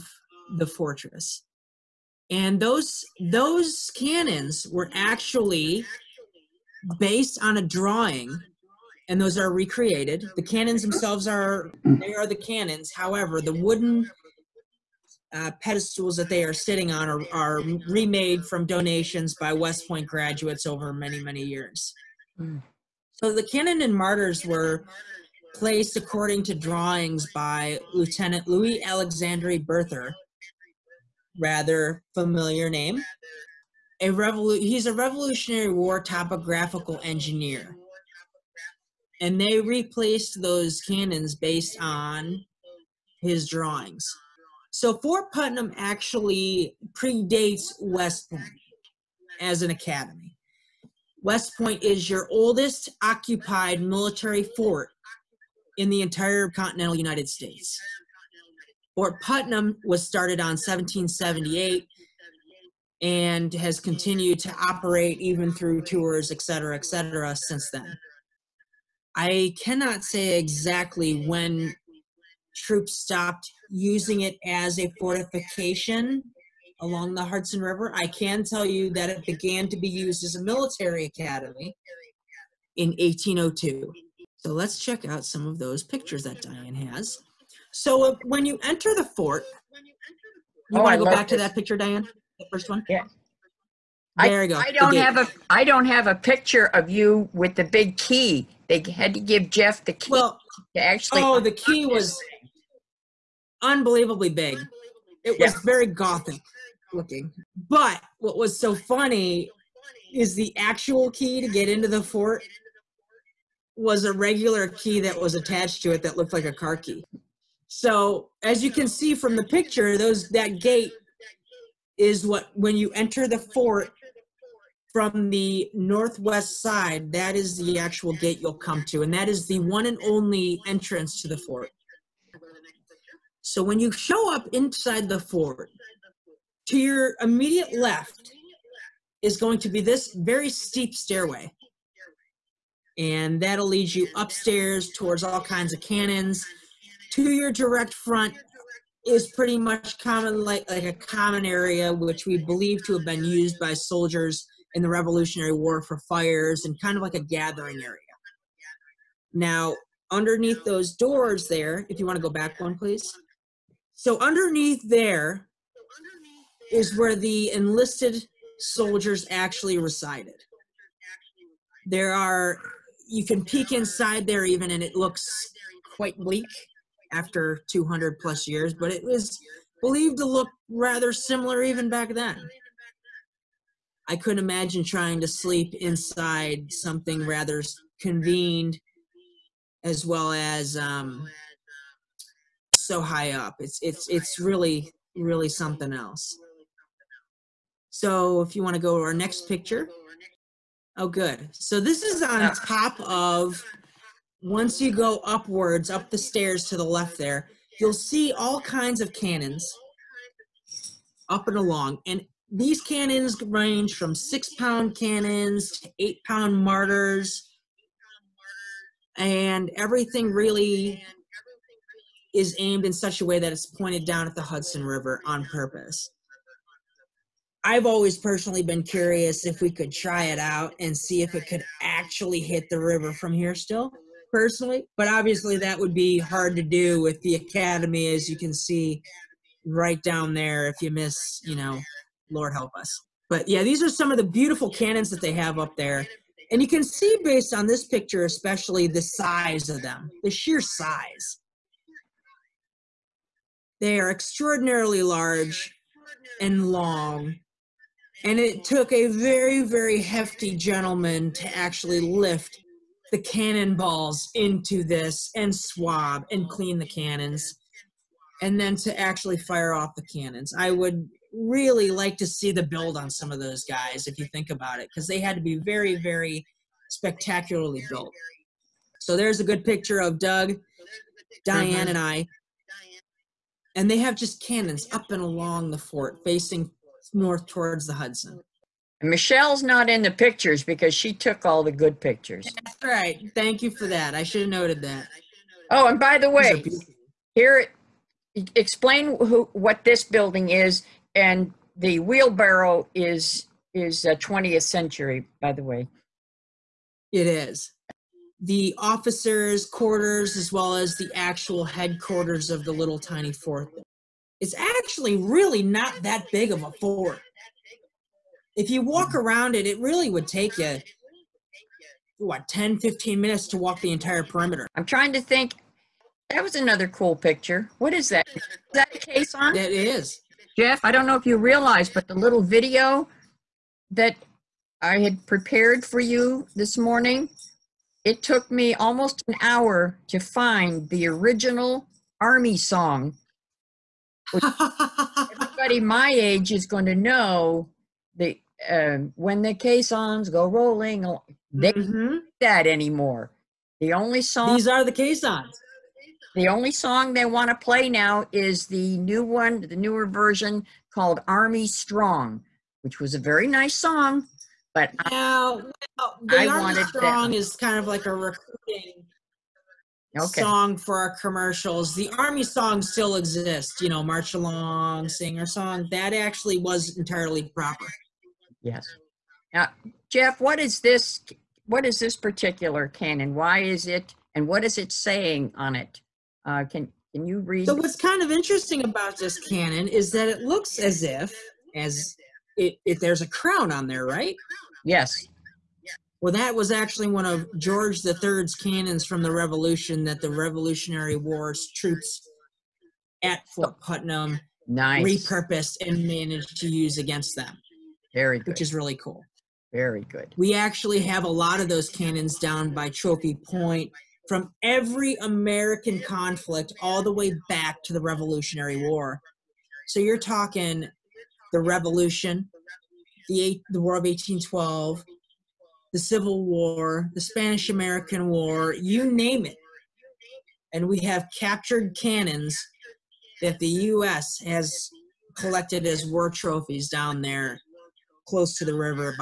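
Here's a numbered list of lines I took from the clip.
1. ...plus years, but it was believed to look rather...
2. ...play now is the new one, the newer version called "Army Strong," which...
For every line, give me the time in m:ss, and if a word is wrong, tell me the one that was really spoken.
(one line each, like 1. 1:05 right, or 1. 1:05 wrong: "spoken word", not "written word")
1. 2:58 right
2. 5:57 right.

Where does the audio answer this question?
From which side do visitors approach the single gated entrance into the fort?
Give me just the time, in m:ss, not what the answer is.
2:05.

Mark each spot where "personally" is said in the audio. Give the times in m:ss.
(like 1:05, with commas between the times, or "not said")
3:48, 3:54.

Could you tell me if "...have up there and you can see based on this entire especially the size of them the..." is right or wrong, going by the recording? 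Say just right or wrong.
wrong.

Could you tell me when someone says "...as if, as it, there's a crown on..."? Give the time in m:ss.
6:30.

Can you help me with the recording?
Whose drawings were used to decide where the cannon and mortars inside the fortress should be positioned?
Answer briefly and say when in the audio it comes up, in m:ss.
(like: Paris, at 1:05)
Louis Alexandre Berthier, at 0:28.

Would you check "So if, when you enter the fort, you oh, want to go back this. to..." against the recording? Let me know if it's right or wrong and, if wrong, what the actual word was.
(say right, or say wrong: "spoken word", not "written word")
right.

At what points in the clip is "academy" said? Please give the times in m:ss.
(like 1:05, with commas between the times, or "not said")
0:49, 1:21, 3:57.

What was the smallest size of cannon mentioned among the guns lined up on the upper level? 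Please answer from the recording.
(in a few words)
six pound.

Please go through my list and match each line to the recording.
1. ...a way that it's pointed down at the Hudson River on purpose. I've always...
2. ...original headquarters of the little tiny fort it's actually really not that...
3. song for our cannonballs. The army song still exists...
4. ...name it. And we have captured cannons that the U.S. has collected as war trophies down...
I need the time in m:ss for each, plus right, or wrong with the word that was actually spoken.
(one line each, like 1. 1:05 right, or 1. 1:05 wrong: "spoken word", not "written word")
1. 3:43 right
2. 5:11 wrong: "actual", not "original"
3. 6:10 wrong: "commercials", not "cannonballs"
4. 7:09 right.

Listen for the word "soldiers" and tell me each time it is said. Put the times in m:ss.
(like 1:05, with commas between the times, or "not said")
2:33, 2:48.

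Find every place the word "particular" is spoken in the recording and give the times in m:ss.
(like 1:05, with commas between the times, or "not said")
6:22.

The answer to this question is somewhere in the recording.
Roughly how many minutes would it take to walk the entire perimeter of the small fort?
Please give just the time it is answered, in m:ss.
5:22.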